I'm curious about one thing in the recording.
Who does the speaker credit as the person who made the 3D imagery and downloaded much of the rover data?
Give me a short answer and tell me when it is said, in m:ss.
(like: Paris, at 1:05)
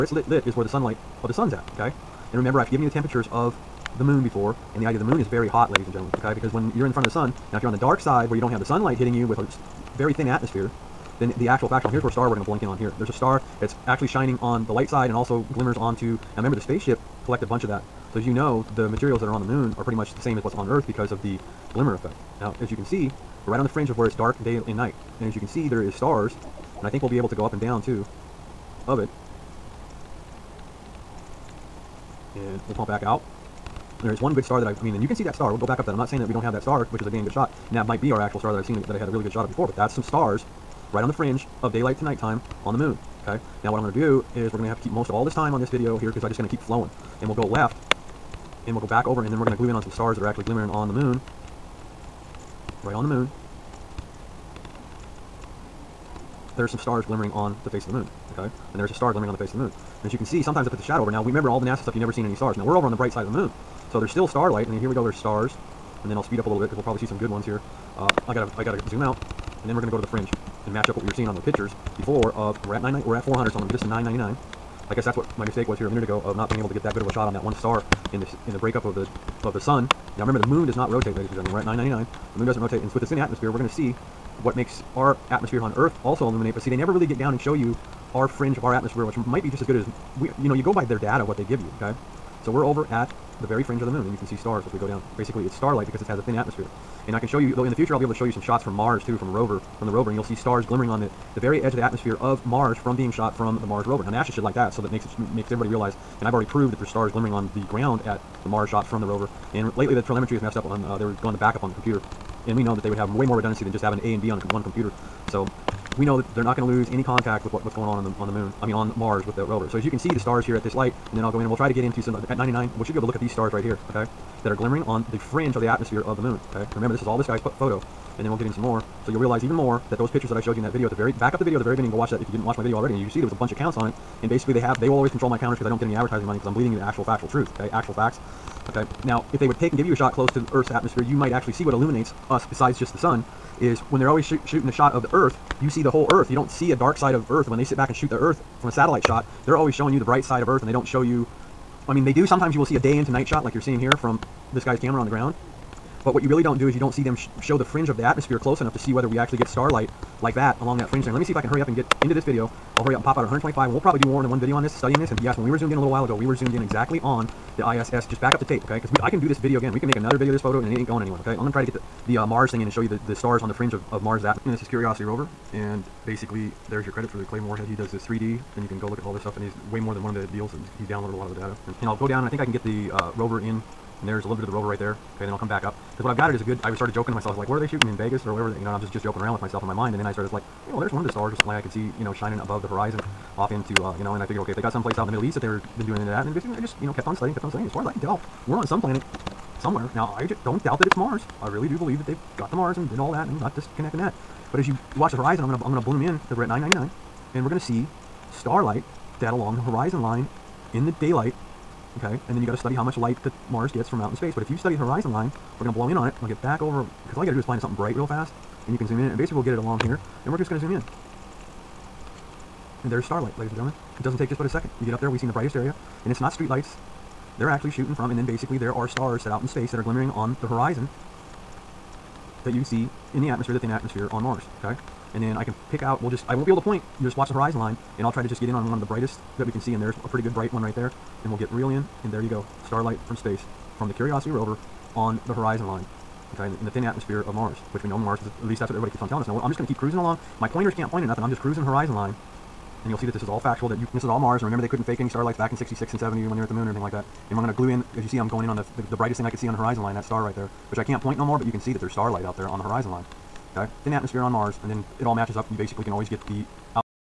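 the Claymore Warhead, at 2:57.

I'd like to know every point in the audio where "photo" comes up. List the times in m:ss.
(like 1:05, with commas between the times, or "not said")
2:07, 2:50.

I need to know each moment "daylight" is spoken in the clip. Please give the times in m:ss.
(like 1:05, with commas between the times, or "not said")
0:41, 3:31.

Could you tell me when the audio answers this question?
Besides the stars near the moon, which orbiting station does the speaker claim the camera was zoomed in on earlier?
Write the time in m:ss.
2:47.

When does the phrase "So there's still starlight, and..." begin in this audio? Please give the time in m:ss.
1:03.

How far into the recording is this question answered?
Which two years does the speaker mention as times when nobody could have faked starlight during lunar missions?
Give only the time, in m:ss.
4:15.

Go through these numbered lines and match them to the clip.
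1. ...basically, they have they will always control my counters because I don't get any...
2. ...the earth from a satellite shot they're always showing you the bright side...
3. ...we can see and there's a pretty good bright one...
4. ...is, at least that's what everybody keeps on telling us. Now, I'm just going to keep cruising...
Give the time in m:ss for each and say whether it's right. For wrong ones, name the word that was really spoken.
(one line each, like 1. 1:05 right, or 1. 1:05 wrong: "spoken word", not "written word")
1. 2:14 right
2. 2:28 right
3. 3:59 right
4. 4:08 right.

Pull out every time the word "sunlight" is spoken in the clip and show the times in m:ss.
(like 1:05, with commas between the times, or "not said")
0:00, 0:08.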